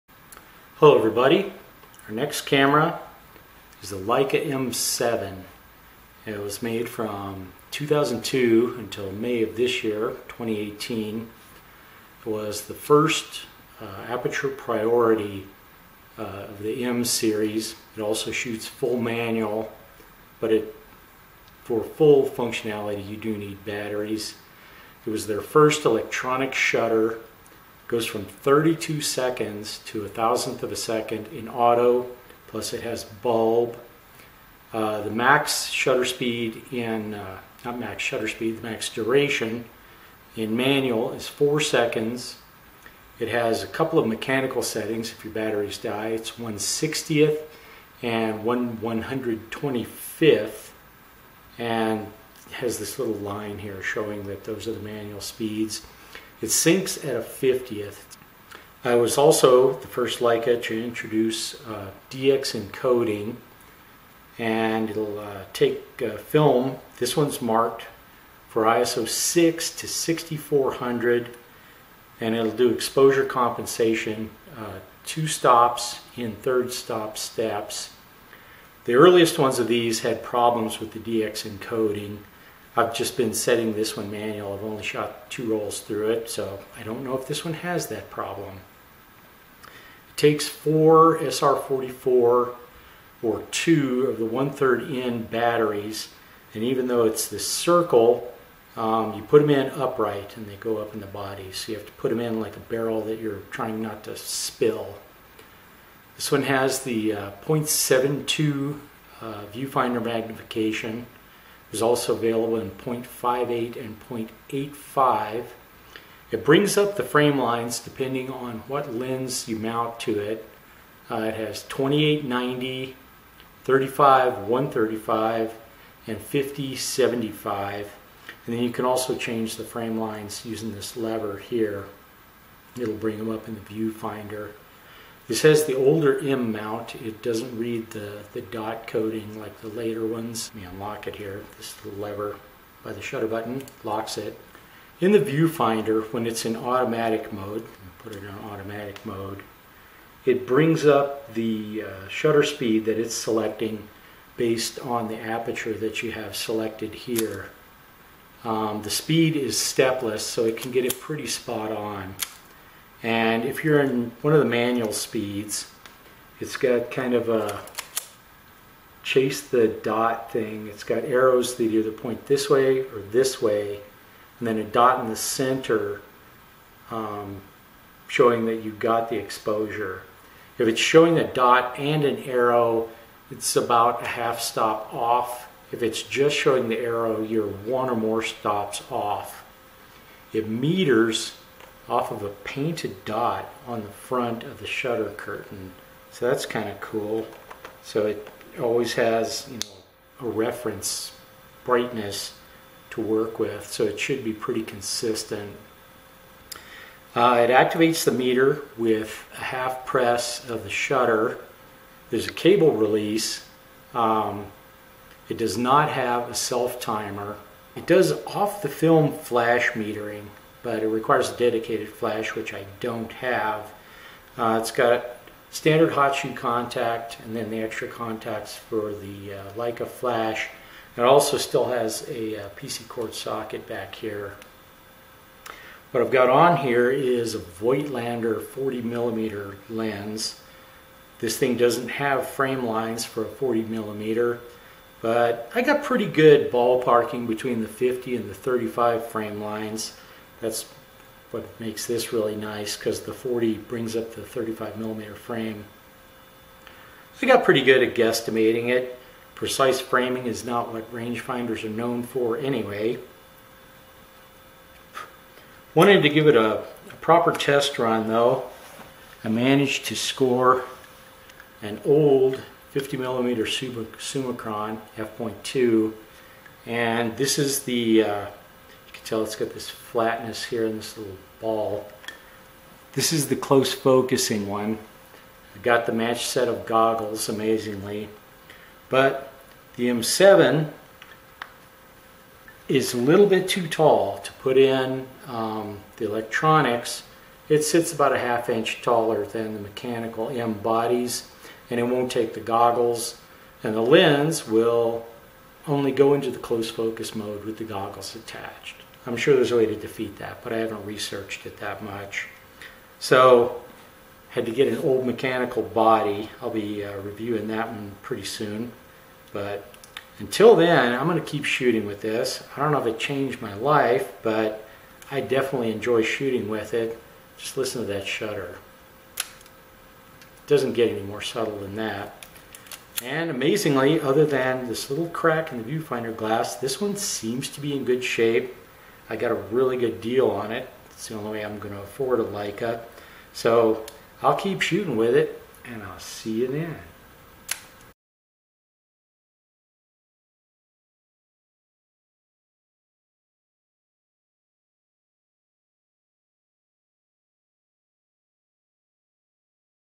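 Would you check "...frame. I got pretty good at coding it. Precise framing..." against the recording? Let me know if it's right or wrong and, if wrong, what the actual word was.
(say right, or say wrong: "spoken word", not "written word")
wrong: "guesstimating", not "coding".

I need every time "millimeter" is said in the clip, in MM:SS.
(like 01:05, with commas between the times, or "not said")
03:58, 04:03, 04:14, 04:32.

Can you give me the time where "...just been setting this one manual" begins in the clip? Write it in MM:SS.
01:22.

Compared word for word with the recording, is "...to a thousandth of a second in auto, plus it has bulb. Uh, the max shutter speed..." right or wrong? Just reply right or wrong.
right.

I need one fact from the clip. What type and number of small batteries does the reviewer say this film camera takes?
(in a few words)
4 SR44.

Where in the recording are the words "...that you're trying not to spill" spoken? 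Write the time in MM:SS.
01:43.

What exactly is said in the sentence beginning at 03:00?
If it's showing a dot and an arrow, it's about a half stop off.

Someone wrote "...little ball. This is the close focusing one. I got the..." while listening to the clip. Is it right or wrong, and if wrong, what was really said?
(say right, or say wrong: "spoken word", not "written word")
right.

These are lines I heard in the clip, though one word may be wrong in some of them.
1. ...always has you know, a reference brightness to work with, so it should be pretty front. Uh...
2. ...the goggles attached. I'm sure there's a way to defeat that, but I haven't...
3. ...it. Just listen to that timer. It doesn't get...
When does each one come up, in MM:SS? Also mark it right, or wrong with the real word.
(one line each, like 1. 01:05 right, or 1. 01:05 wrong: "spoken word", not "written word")
1. 03:18 wrong: "consistent", not "front"
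2. 05:07 right
3. 05:26 wrong: "shutter", not "timer".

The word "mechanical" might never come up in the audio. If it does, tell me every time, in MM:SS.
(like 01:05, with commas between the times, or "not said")
00:44, 04:59, 05:15.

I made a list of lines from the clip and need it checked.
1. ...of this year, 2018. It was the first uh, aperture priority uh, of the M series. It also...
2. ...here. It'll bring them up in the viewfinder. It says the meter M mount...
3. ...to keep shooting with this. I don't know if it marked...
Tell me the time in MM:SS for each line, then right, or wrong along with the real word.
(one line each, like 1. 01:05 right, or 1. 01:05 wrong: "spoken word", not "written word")
1. 00:09 right
2. 02:11 wrong: "older", not "meter"
3. 05:21 wrong: "changed", not "marked".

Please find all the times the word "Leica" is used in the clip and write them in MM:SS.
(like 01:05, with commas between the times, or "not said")
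00:03, 01:00, 03:49, 05:42.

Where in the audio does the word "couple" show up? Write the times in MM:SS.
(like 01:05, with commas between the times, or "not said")
00:43.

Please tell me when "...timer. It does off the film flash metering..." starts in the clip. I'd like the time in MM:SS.
03:36.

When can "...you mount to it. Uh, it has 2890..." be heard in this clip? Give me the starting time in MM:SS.
01:59.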